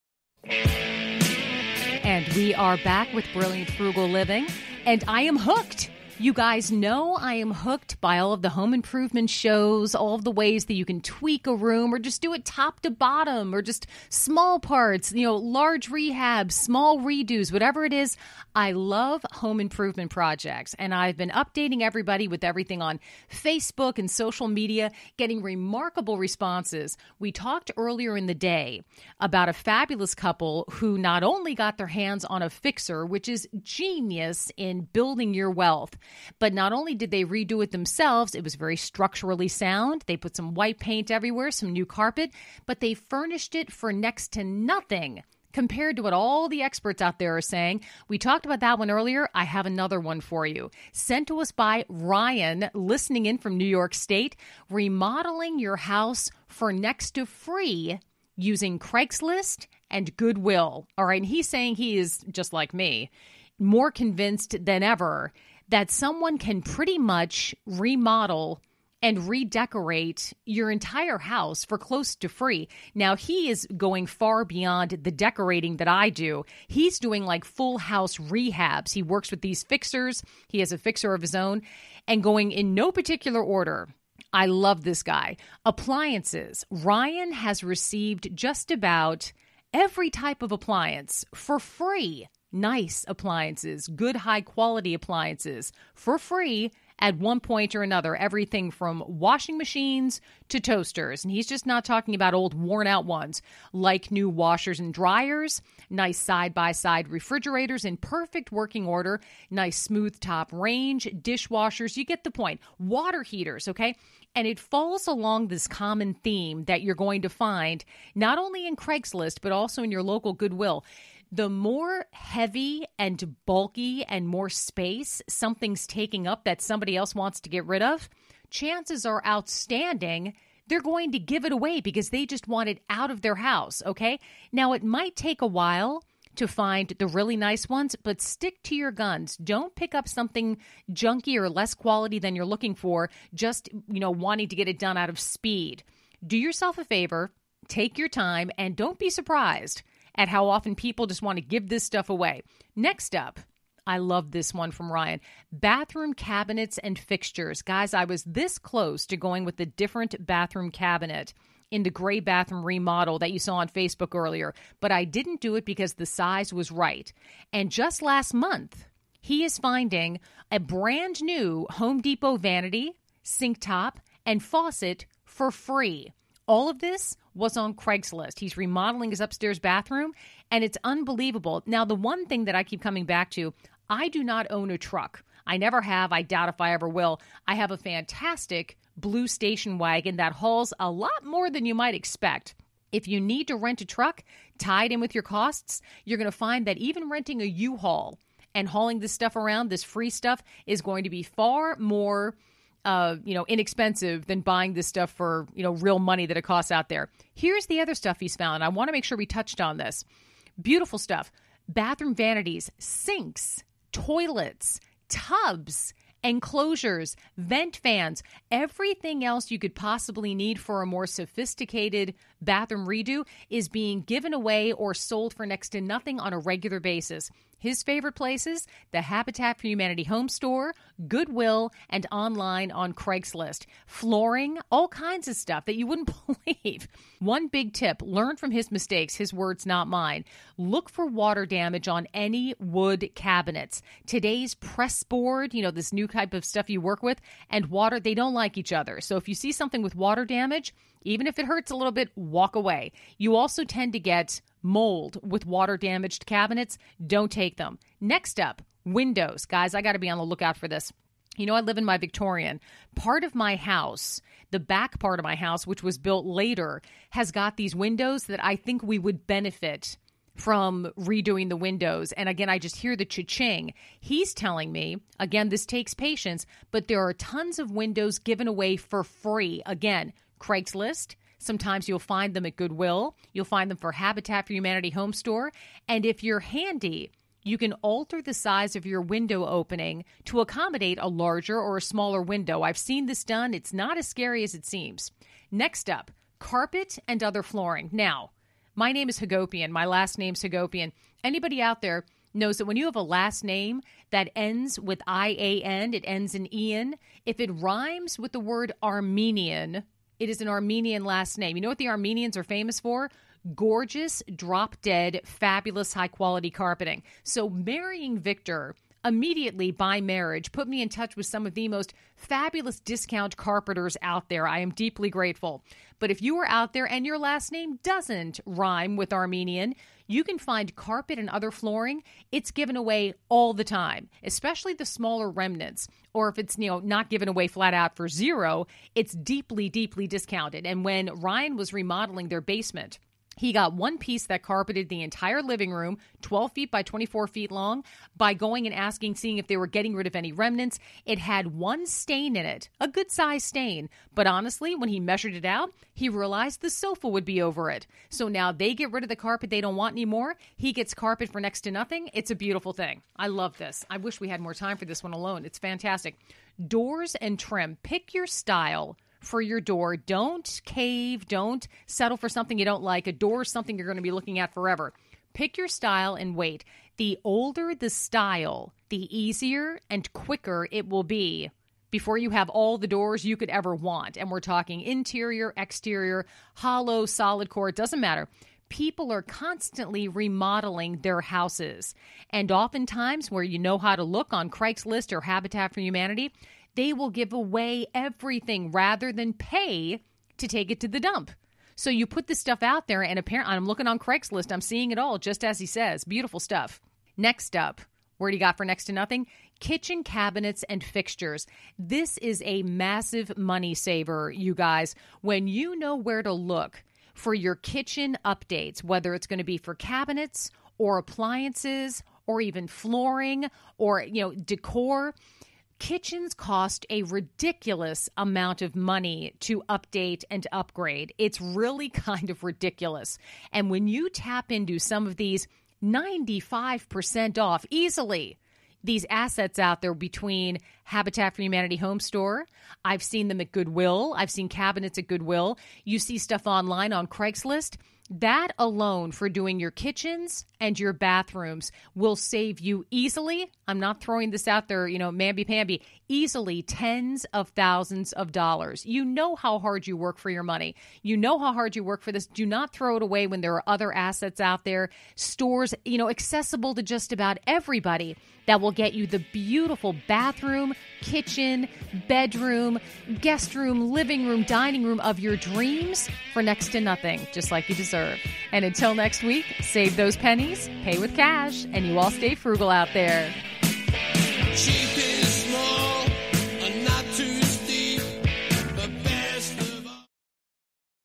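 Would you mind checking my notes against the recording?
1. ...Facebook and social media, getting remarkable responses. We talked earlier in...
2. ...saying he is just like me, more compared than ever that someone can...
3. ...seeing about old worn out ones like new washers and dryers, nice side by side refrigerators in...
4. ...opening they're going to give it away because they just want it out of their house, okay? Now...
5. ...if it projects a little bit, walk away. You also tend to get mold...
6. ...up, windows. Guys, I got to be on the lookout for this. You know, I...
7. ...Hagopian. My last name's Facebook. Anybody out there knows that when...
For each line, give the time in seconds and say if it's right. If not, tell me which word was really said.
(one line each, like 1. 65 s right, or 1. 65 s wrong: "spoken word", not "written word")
1. 23 s right
2. 61 s wrong: "convinced", not "compared"
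3. 101 s wrong: "talking", not "seeing"
4. 129 s wrong: "outstanding", not "opening"
5. 251 s wrong: "hurts", not "projects"
6. 258 s right
7. 299 s wrong: "Hagopian", not "Facebook".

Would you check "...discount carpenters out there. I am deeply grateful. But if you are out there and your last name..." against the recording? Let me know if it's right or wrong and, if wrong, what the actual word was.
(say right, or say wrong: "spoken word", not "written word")
right.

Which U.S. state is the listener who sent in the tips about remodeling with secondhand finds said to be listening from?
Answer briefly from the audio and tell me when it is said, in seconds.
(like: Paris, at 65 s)
New York State, at 53 s.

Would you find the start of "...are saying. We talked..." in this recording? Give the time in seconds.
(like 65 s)
47 s.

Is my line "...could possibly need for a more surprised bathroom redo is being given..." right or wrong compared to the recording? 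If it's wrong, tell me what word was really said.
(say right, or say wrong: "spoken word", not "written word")
wrong: "sophisticated", not "surprised".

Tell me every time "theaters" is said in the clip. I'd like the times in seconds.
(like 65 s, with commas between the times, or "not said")
not said.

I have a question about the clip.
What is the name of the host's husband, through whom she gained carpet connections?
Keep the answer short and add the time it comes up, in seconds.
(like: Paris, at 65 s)
Victor, at 318 s.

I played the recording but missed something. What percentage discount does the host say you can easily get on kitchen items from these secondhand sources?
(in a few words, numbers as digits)
95%.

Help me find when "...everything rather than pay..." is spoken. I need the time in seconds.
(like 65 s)
397 s.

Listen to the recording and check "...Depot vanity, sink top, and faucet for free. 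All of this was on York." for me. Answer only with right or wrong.
wrong.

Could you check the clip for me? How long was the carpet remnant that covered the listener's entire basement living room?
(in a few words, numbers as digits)
24 feet.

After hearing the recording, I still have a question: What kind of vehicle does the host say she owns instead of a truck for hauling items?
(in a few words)
Blue station wagon.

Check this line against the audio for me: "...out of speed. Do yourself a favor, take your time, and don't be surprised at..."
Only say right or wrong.
right.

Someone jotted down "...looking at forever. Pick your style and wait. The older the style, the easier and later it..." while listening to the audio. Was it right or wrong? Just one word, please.
wrong.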